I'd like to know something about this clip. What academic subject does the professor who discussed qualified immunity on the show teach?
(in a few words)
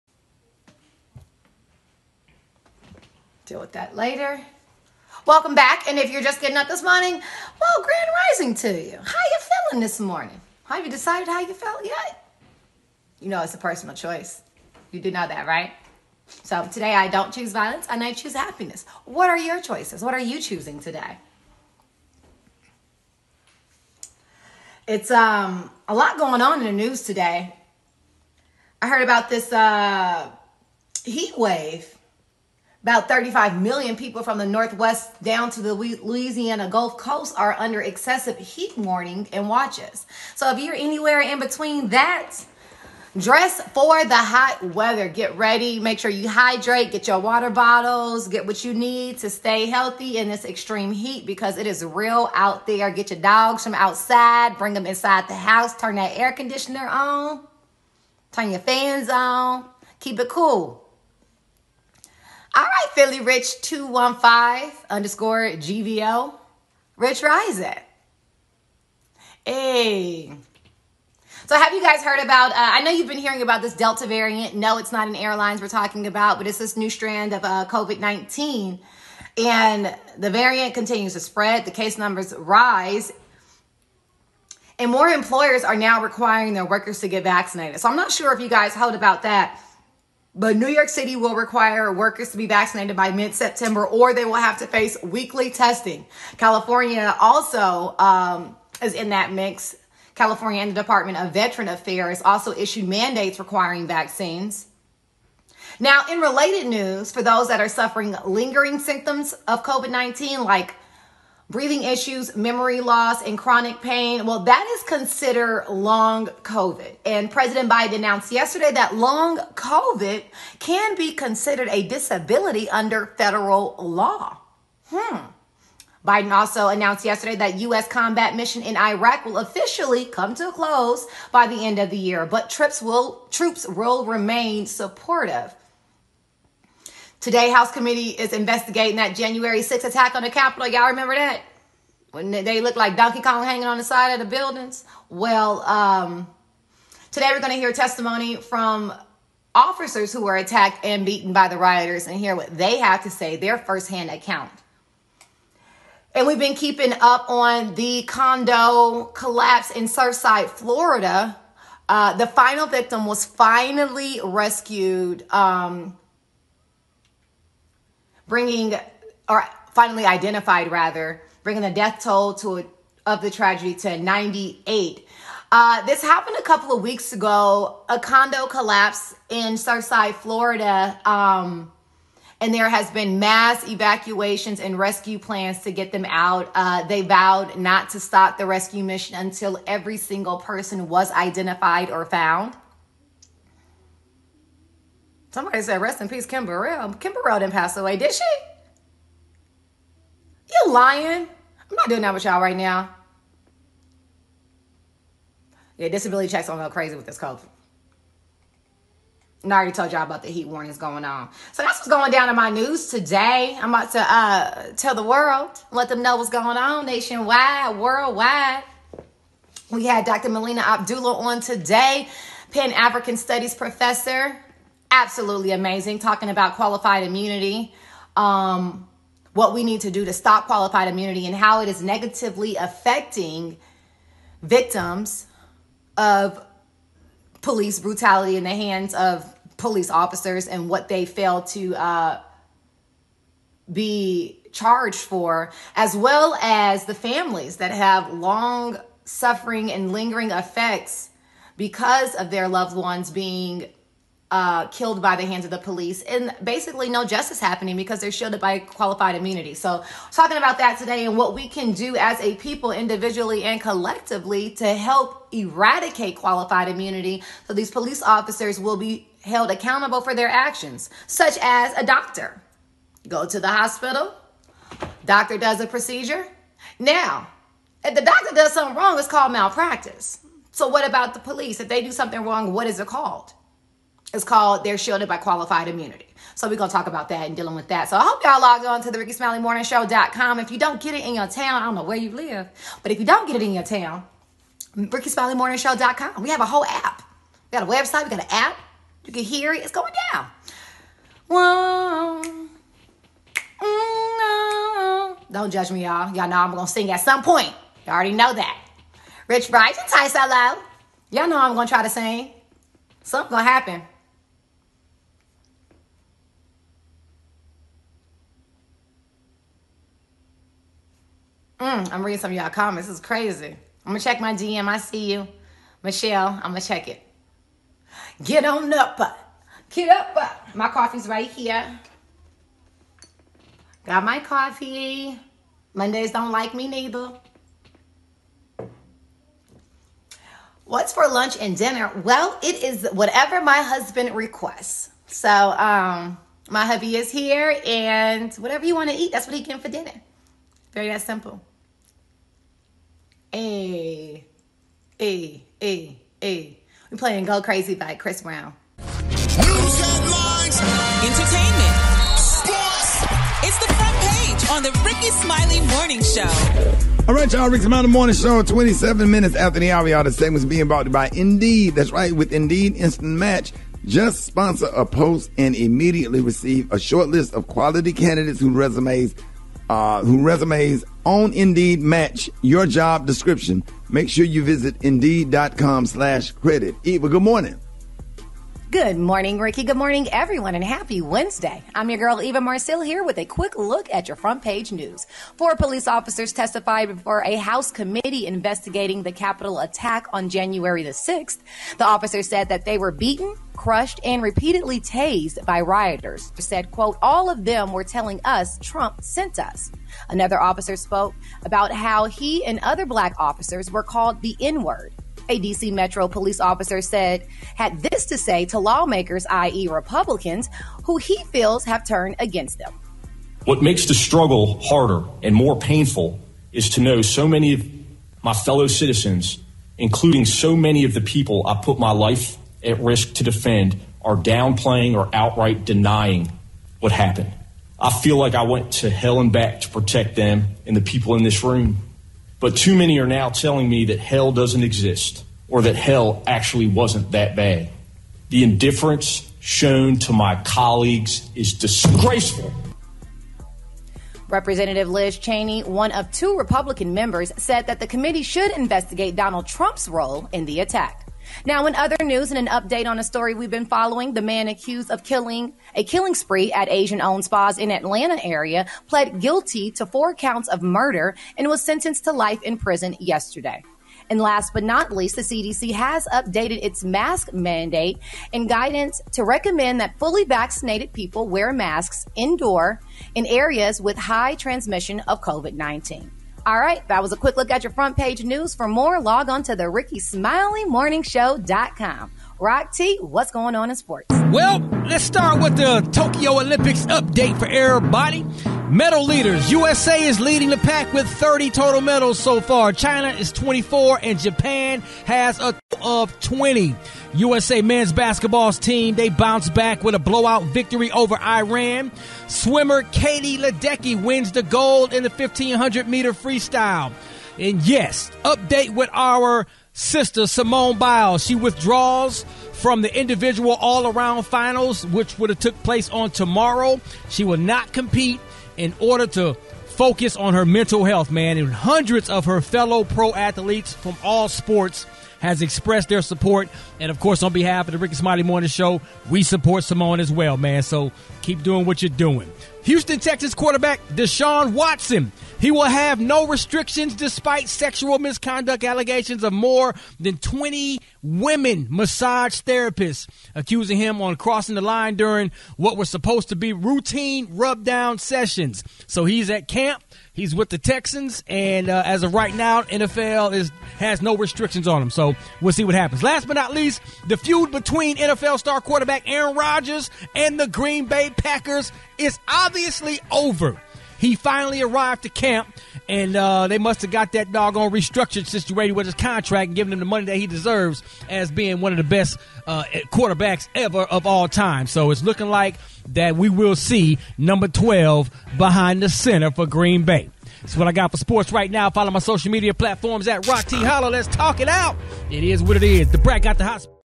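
Pan African Studies.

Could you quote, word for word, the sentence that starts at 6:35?
Four police officers testified before a House committee investigating the Capitol attack on January the 6th.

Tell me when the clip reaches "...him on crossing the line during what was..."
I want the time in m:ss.
9:13.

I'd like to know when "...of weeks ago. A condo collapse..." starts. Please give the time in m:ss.
2:56.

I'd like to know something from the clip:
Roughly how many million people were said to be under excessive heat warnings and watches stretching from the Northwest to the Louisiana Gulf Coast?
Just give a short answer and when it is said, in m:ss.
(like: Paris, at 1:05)
35, at 0:33.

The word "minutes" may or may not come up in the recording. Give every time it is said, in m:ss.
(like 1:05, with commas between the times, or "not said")
6:09.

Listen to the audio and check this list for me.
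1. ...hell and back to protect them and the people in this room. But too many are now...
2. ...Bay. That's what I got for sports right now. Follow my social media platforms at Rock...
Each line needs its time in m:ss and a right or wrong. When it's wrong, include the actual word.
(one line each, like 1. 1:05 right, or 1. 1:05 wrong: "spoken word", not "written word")
1. 7:18 right
2. 9:49 right.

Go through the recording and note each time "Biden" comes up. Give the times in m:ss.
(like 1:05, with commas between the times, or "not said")
1:57, 2:06.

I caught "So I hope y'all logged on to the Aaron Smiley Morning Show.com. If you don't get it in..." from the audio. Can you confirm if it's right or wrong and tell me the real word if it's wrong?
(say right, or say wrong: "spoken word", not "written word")
wrong: "Rickey", not "Aaron".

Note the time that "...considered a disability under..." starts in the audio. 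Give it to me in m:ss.
2:01.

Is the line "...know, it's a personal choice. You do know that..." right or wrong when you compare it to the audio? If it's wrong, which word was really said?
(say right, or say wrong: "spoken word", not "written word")
right.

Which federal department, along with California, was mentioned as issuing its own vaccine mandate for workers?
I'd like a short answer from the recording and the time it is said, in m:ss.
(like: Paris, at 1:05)
Department of Veteran Affairs, at 1:40.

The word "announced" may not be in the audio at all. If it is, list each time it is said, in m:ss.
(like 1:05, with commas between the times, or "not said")
1:57, 2:06.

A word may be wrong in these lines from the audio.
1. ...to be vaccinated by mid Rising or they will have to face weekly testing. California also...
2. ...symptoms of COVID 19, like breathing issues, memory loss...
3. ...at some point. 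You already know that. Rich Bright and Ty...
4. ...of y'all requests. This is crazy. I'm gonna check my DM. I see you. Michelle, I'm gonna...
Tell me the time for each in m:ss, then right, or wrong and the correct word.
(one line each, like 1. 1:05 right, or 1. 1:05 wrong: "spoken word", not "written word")
1. 1:32 wrong: "September", not "Rising"
2. 1:48 right
3. 5:06 right
4. 5:22 wrong: "comments", not "requests".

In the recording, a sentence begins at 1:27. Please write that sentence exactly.
So, I'm not sure if you guys heard about that.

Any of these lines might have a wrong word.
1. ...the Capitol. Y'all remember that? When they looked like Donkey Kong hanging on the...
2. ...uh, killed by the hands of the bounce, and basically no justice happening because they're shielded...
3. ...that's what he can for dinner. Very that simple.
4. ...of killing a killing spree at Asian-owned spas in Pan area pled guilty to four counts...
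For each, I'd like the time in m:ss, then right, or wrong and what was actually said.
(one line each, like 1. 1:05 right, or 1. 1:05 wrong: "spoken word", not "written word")
1. 2:20 right
2. 4:14 wrong: "police", not "bounce"
3. 5:49 right
4. 7:44 wrong: "Atlanta", not "Pan".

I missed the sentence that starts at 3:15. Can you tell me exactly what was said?
Somebody said, rest in peace, Kim Burrell.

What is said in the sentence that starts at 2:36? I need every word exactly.
And we've been keeping up on the condo collapse in Surfside, Florida.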